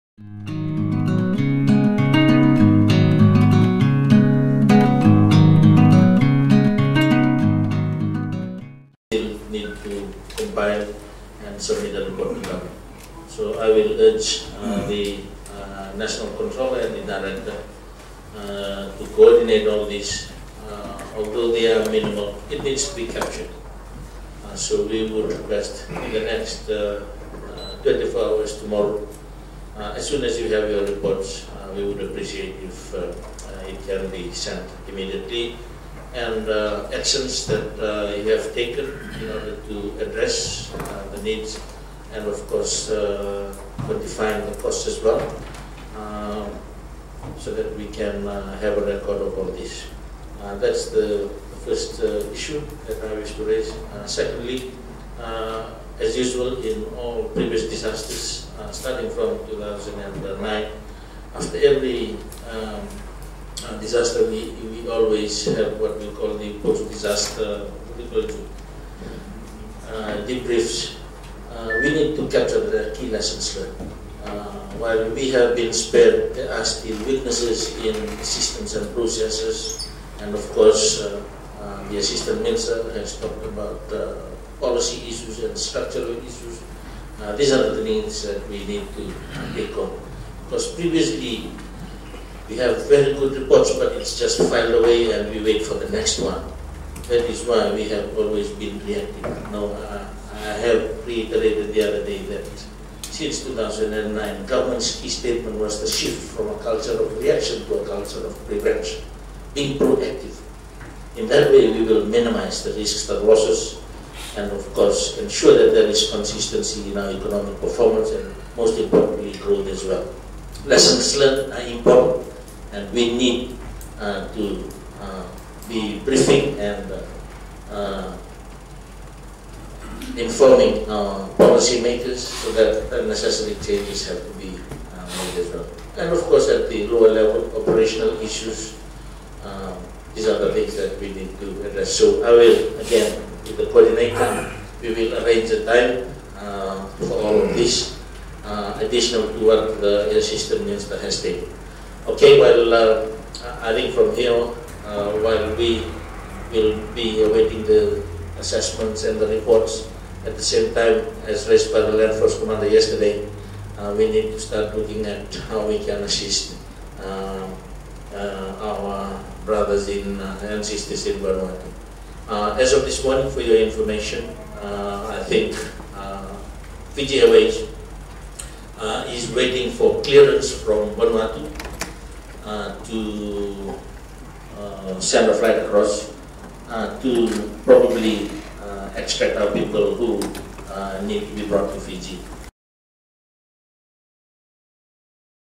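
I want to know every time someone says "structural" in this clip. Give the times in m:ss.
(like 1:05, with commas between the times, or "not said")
1:25.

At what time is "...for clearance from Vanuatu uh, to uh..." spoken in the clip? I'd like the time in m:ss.
2:59.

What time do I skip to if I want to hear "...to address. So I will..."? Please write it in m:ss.
2:21.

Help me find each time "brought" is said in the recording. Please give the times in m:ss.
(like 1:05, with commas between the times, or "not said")
3:11.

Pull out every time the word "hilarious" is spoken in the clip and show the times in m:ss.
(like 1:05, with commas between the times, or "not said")
not said.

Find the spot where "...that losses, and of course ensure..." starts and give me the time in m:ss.
1:53.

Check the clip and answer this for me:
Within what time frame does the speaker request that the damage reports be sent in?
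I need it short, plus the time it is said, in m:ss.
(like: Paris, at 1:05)
24 hours, at 0:27.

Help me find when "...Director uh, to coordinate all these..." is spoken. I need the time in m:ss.
0:17.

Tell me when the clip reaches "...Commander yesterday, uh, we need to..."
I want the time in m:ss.
2:42.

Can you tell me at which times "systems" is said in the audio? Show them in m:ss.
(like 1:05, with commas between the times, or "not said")
1:18, 2:30.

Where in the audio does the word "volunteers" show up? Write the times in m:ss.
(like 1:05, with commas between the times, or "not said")
not said.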